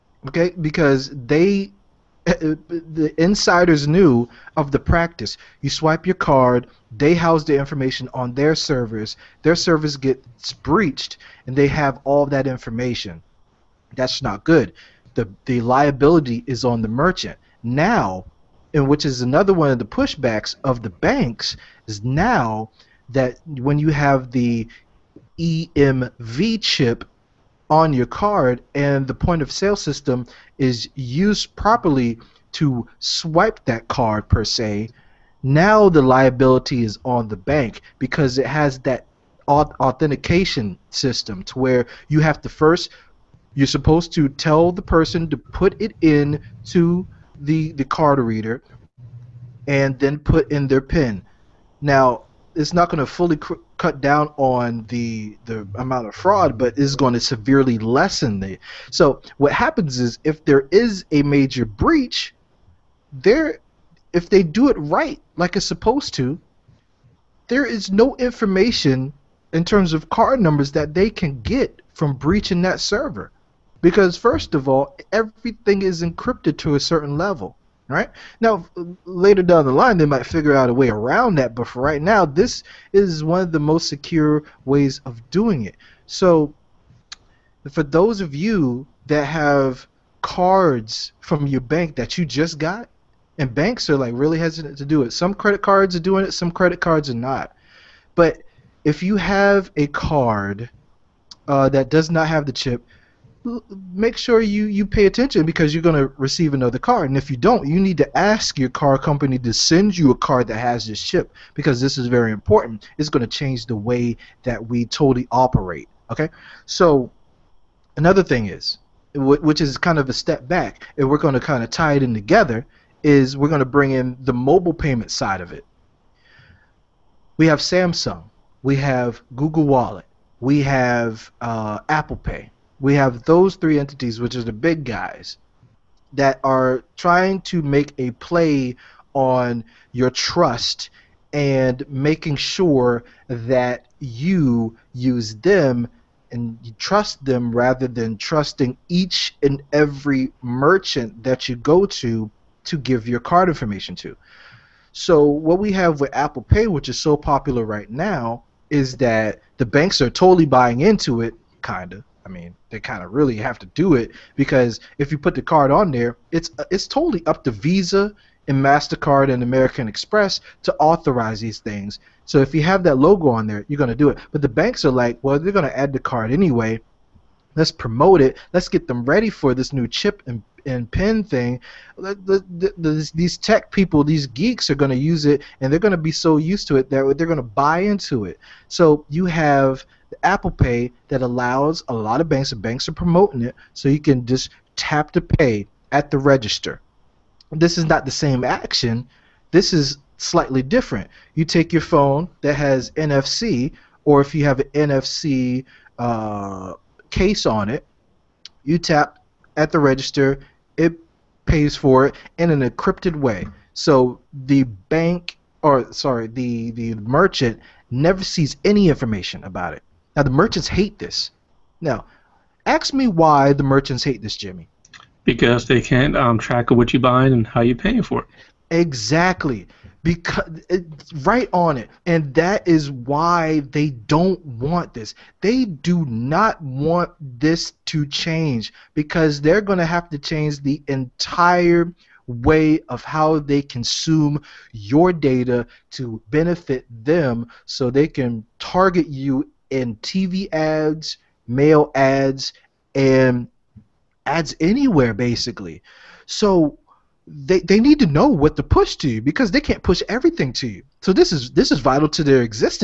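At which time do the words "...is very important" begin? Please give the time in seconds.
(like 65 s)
111 s.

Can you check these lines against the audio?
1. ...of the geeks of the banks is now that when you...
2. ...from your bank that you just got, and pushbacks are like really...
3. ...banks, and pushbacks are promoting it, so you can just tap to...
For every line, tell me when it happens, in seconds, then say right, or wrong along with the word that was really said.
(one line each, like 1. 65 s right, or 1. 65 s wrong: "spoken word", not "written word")
1. 19 s wrong: "pushbacks", not "geeks"
2. 91 s wrong: "banks", not "pushbacks"
3. 192 s wrong: "banks", not "pushbacks".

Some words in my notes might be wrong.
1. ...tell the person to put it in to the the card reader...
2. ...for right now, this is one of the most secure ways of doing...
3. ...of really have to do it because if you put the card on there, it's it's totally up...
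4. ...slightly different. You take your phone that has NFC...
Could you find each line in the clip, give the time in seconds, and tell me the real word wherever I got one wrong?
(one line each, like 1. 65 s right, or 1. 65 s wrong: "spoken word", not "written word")
1. 44 s right
2. 81 s right
3. 163 s right
4. 200 s right.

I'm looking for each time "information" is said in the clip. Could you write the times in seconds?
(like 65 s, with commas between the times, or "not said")
7 s, 12 s, 68 s, 153 s, 218 s.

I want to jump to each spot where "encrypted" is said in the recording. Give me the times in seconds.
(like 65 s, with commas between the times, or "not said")
76 s, 212 s.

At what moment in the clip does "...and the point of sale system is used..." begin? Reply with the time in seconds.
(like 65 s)
28 s.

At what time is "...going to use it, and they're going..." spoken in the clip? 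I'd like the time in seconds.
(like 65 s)
184 s.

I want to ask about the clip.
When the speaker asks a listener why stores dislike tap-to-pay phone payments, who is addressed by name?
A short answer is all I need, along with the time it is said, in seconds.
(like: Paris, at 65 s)
Jimmy, at 224 s.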